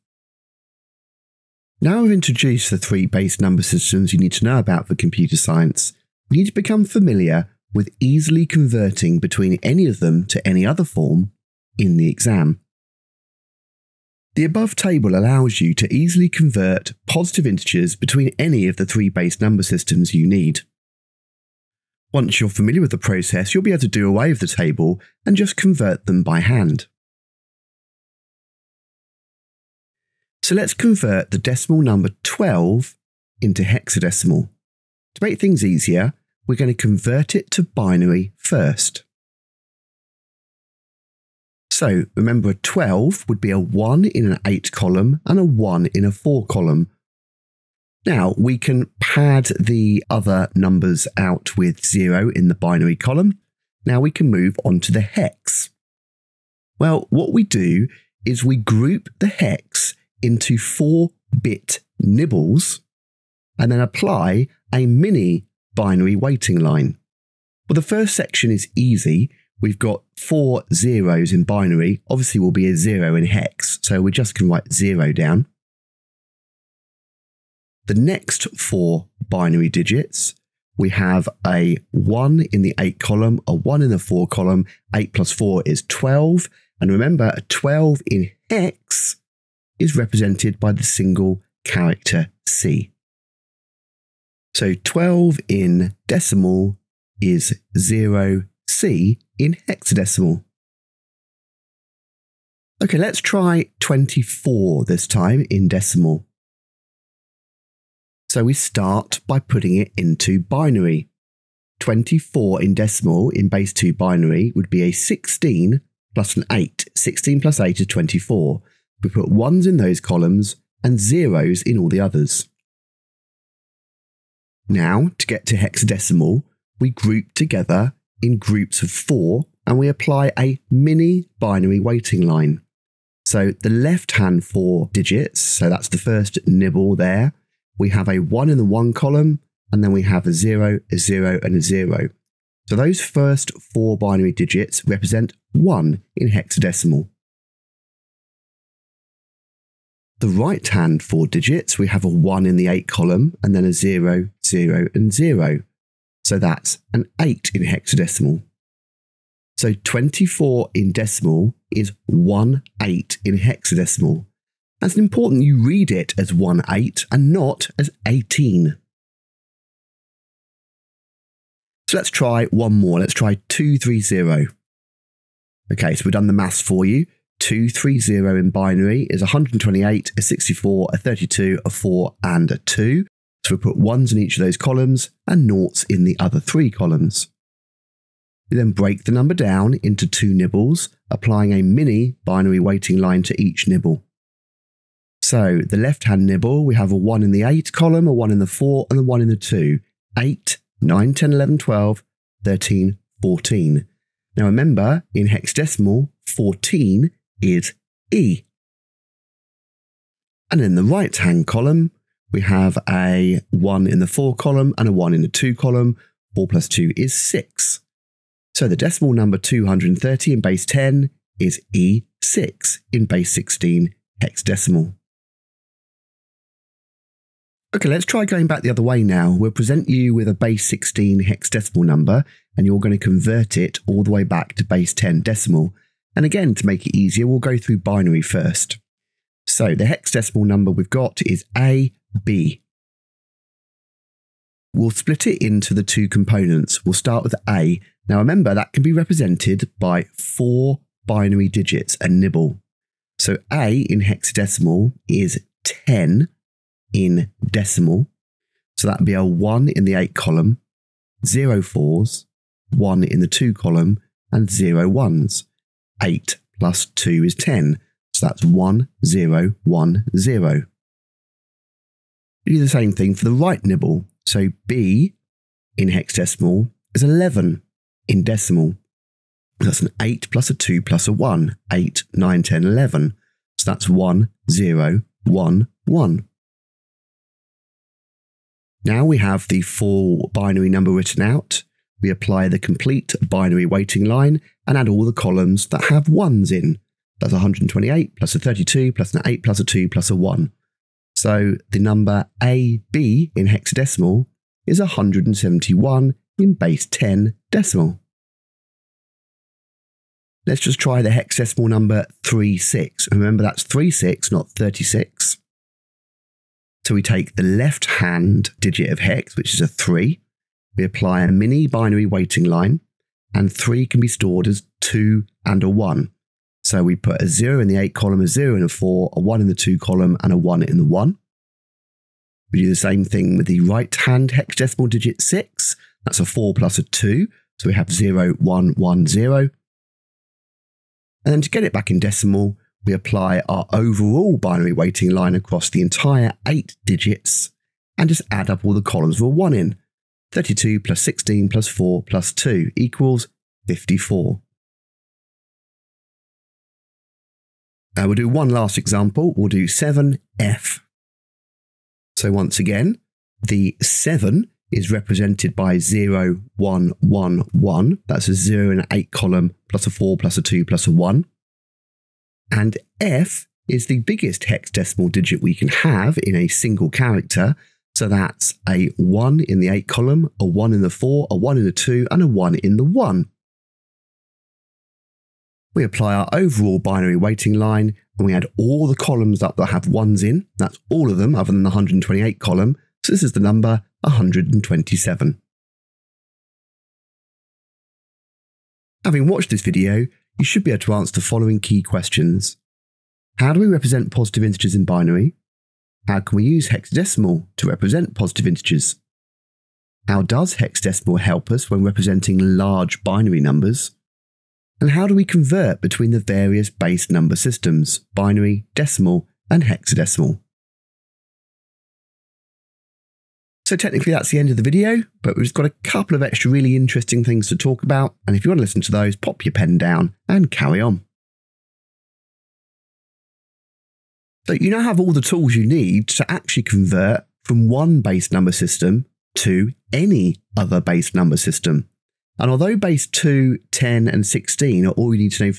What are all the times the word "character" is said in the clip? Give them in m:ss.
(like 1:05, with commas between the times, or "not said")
1:31, 6:16.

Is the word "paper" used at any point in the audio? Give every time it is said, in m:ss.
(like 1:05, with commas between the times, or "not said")
not said.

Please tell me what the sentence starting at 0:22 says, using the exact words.
Once you're familiar with the process, you'll be able to do away with the table and just convert them by hand.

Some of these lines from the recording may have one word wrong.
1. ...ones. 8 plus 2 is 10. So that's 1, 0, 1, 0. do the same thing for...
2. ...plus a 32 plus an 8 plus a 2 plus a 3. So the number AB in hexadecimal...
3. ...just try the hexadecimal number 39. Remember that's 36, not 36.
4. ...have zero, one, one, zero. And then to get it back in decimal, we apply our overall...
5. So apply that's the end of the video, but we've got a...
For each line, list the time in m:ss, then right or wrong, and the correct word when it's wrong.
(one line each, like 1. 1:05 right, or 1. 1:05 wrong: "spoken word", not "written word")
1. 4:24 right
2. 4:58 wrong: "1", not "3"
3. 5:10 wrong: "36", not "39"
4. 5:37 right
5. 7:03 wrong: "technically", not "apply".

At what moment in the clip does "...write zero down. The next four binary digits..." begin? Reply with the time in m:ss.
1:14.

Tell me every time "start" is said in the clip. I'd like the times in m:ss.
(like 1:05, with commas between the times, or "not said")
1:48, 4:06.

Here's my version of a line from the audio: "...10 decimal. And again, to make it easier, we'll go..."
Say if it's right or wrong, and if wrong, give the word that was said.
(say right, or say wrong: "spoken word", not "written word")
right.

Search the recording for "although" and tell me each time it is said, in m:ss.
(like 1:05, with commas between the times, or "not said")
7:22.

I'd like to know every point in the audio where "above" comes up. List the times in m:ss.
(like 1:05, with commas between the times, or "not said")
0:14.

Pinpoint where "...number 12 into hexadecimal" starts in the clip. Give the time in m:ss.
0:31.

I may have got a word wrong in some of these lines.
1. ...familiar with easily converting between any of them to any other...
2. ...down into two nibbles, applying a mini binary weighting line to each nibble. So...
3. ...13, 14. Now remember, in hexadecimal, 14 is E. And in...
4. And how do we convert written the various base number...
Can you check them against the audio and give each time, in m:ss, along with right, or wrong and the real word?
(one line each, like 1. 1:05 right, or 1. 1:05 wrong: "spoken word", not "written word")
1. 0:06 right
2. 3:09 right
3. 3:22 right
4. 6:54 wrong: "between", not "written".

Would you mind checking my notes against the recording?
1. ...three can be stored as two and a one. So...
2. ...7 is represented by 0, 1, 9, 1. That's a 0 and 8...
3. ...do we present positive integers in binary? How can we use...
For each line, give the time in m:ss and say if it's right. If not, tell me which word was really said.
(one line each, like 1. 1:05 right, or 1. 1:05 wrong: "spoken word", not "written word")
1. 5:23 right
2. 6:03 wrong: "1", not "9"
3. 6:43 wrong: "represent", not "present".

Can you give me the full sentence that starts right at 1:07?
Well, the first section is easy.